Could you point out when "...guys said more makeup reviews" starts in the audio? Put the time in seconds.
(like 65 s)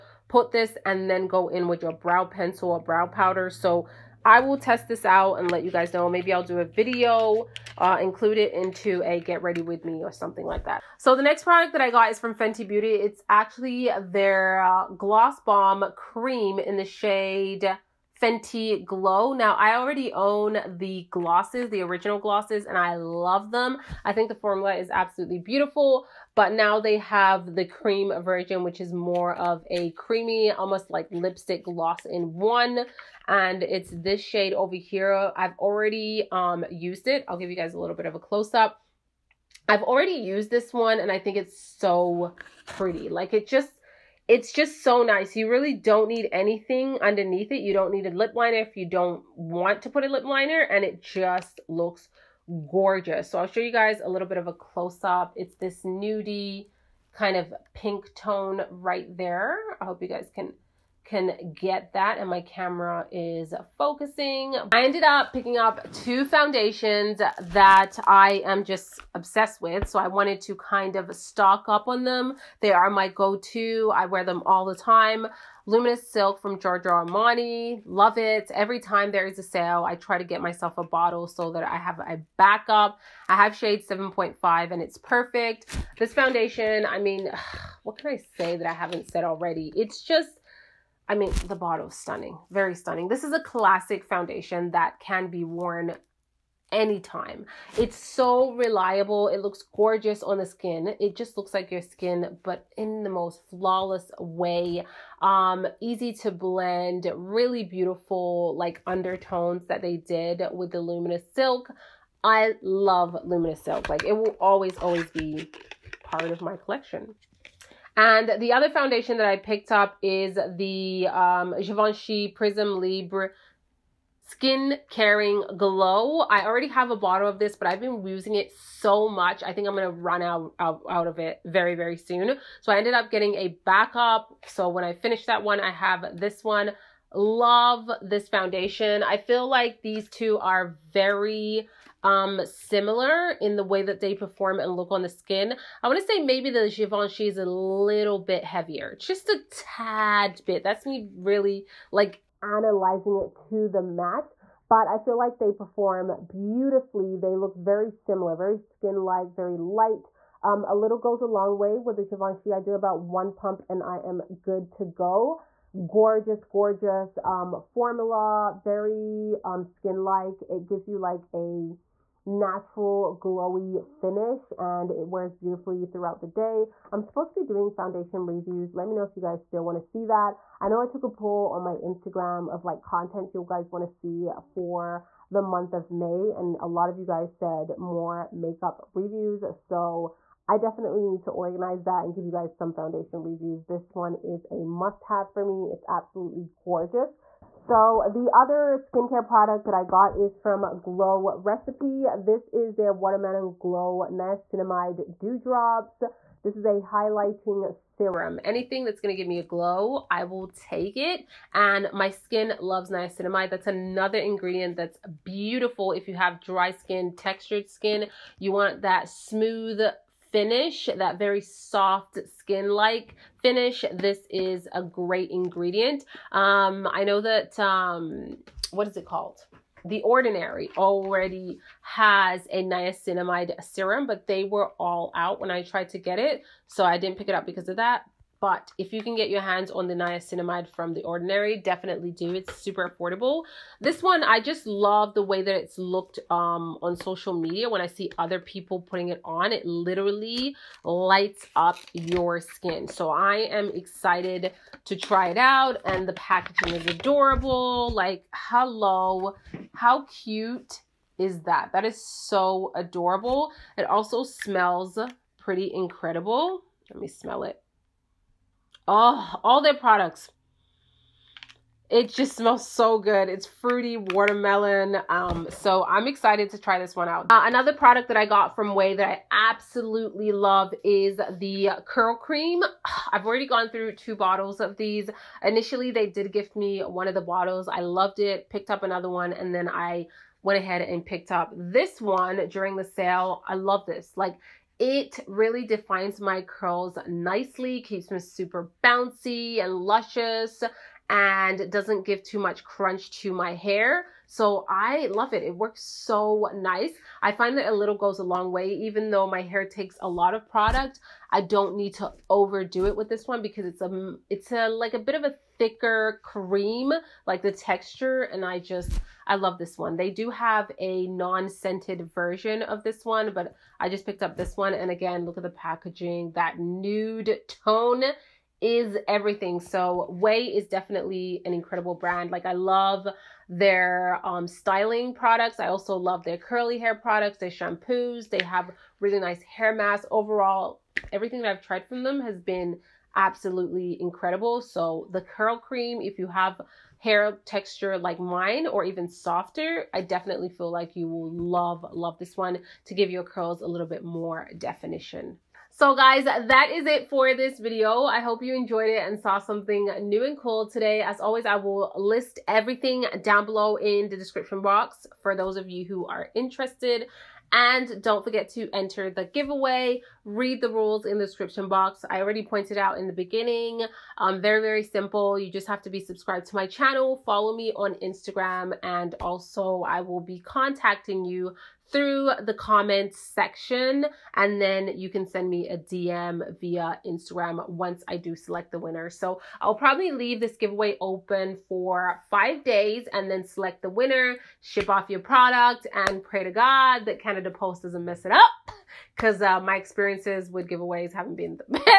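187 s.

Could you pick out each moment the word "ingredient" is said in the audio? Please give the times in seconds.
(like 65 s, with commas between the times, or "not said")
214 s, 225 s.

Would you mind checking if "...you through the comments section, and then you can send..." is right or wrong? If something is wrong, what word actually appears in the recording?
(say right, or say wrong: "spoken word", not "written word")
right.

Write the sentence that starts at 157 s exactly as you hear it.
They look very similar, very skin-like, very light.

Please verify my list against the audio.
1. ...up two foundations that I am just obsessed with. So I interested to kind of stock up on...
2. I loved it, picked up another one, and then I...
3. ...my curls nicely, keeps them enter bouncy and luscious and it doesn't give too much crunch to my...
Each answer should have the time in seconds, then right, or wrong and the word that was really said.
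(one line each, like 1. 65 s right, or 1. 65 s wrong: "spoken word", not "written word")
1. 65 s wrong: "wanted", not "interested"
2. 287 s right
3. 296 s wrong: "super", not "enter".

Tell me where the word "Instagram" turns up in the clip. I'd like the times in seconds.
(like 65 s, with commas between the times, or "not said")
181 s, 378 s, 387 s.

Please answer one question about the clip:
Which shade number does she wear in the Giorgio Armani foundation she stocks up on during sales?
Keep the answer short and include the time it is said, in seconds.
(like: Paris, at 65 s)
7.5, at 83 s.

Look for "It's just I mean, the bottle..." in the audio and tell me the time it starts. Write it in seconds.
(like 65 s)
89 s.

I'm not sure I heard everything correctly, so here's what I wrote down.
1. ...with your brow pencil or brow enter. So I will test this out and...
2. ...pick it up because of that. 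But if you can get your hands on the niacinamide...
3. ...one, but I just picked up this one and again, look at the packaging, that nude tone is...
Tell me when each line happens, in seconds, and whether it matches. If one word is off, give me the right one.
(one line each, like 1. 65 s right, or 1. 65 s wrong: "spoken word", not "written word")
1. 1 s wrong: "powder", not "enter"
2. 237 s right
3. 323 s right.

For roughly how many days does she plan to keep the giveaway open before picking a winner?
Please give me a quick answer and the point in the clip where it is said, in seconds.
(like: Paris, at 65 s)
5, at 392 s.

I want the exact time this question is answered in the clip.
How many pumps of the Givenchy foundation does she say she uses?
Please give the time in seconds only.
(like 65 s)
163 s.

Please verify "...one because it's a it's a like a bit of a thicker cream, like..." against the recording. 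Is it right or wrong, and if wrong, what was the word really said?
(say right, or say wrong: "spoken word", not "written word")
right.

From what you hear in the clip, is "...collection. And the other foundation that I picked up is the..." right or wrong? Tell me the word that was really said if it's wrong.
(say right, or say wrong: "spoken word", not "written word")
right.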